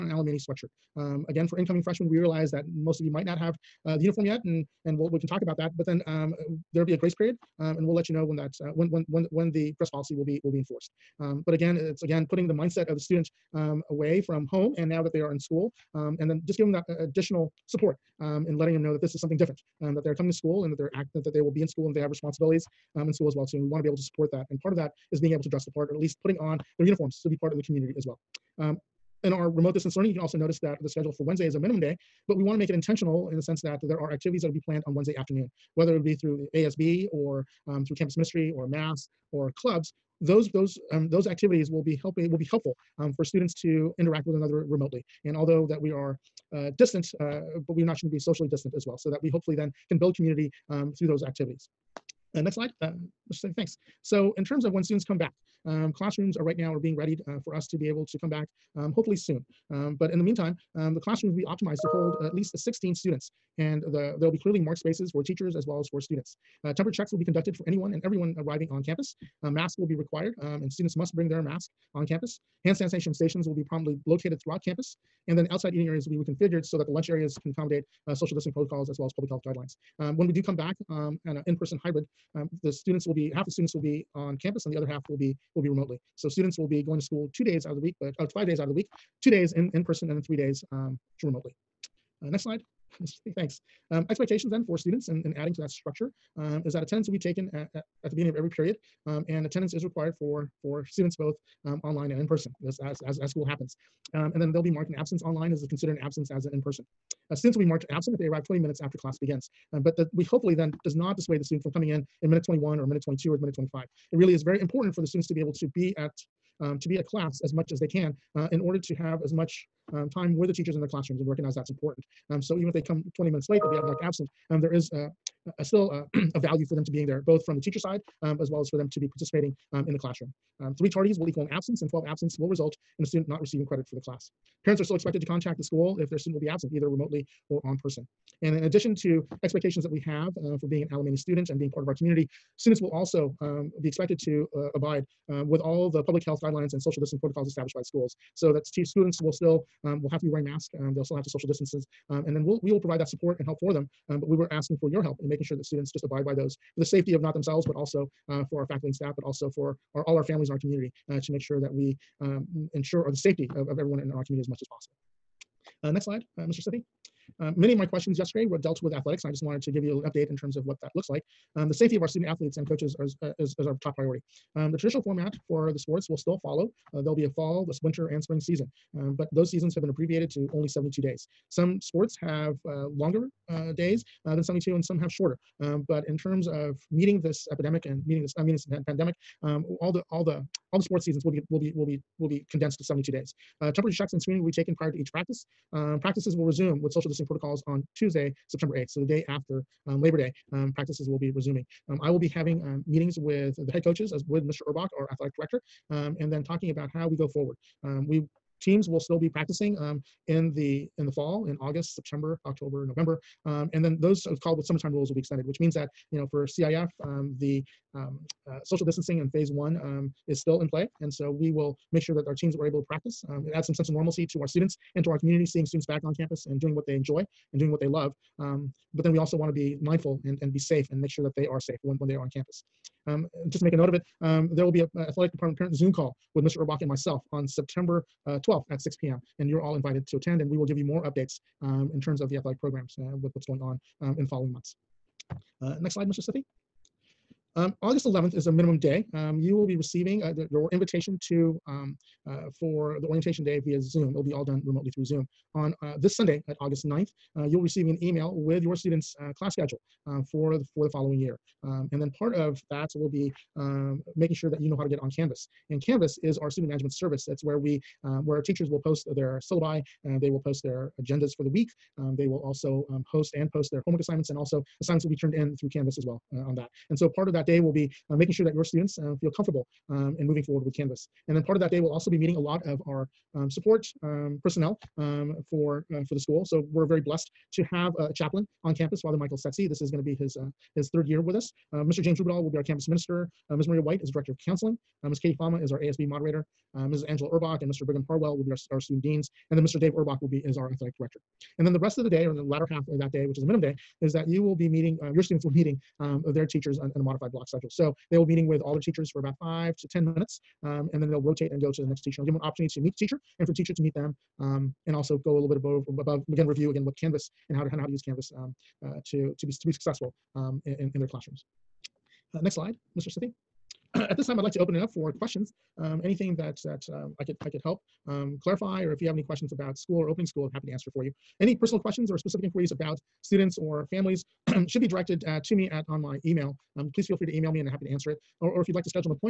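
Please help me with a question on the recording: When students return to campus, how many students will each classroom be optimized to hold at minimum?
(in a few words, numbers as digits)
16.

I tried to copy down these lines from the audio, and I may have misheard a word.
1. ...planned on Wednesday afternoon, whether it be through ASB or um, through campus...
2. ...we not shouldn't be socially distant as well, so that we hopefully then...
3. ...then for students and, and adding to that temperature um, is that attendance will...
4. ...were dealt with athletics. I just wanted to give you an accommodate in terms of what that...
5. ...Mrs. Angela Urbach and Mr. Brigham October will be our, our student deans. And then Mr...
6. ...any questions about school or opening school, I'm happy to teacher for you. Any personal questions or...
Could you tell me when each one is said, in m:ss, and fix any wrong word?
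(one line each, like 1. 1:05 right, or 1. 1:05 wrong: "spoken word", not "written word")
1. 0:34 right
2. 0:47 right
3. 1:34 wrong: "structure", not "temperature"
4. 2:48 wrong: "update", not "accommodate"
5. 4:56 wrong: "Harwell", not "October"
6. 5:29 wrong: "answer", not "teacher".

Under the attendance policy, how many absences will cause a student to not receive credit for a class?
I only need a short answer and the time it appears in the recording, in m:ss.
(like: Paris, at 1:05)
12, at 2:11.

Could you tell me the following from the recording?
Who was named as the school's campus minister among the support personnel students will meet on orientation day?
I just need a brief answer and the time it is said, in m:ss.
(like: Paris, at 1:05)
James Rubidal, at 4:52.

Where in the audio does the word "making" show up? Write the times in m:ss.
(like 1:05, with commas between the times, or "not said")
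2:35, 4:24, 4:38.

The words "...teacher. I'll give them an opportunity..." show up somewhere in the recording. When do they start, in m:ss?
5:12.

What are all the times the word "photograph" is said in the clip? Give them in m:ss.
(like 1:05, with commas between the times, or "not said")
not said.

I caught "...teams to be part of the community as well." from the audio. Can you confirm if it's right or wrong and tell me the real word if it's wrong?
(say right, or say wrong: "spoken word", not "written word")
wrong: "uniforms", not "teams".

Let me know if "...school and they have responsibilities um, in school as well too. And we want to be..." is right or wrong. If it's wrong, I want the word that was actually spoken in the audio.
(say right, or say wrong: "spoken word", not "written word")
right.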